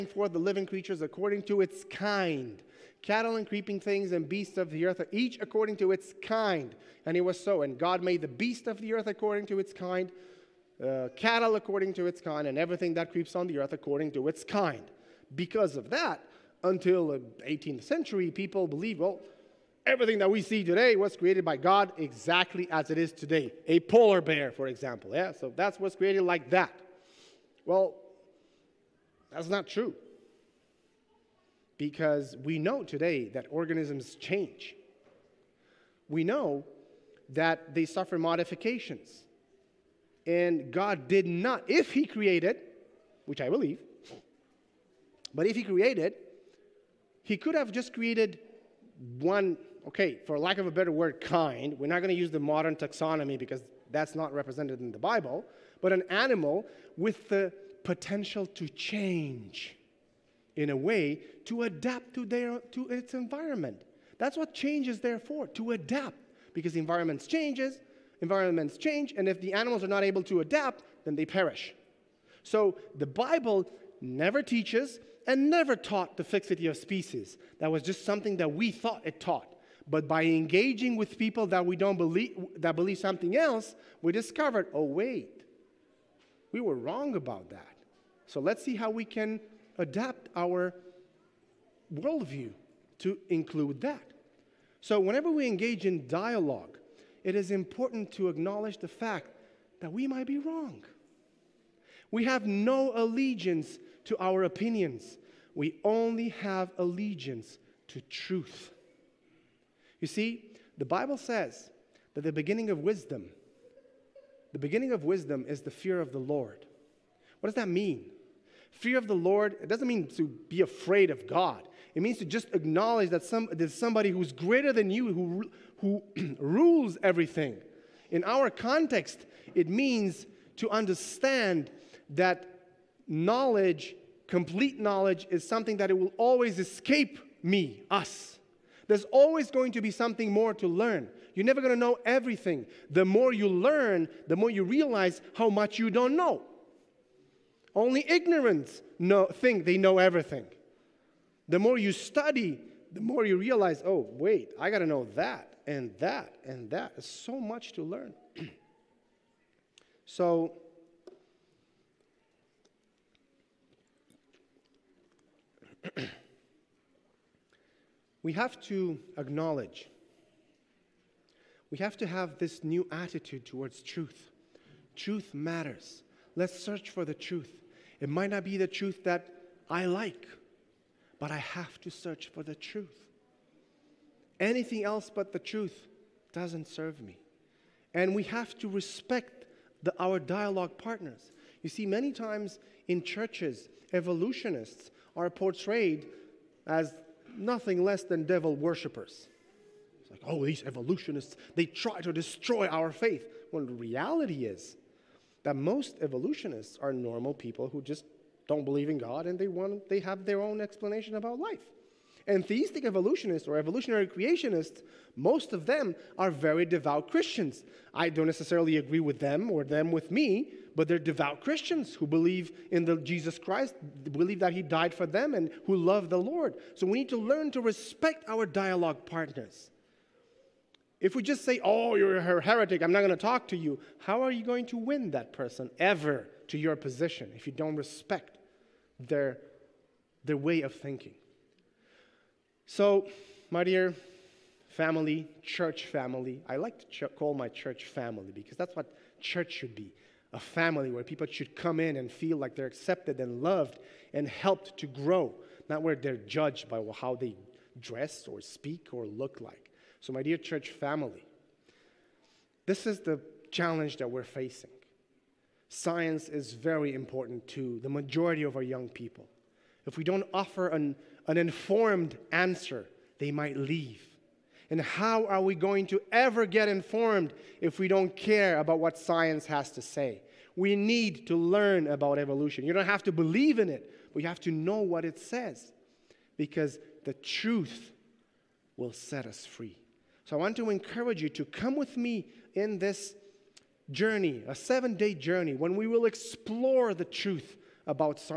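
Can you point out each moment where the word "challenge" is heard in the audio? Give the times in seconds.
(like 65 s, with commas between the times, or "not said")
263 s.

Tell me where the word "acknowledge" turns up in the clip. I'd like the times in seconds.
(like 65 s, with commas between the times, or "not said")
98 s, 122 s, 169 s.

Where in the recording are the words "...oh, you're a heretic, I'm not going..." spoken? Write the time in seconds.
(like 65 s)
231 s.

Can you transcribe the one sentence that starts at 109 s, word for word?
You see, the Bible says that the beginning of wisdom, the beginning of wisdom is the fear of the Lord.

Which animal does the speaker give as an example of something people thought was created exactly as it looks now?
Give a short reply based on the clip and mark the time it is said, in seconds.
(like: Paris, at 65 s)
Polar bear, at 23 s.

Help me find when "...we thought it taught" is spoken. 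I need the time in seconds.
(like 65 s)
78 s.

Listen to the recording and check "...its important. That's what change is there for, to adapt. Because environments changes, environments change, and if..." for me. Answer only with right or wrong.
wrong.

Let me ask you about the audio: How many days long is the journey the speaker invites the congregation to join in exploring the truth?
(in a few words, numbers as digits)
7.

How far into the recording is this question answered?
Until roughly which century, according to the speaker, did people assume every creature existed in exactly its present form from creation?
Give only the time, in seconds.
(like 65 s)
17 s.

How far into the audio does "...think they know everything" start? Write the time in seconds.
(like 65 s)
149 s.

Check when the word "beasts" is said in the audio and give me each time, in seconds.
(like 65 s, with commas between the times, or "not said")
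4 s, 8 s.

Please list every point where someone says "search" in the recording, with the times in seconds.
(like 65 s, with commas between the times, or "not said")
176 s, 181 s.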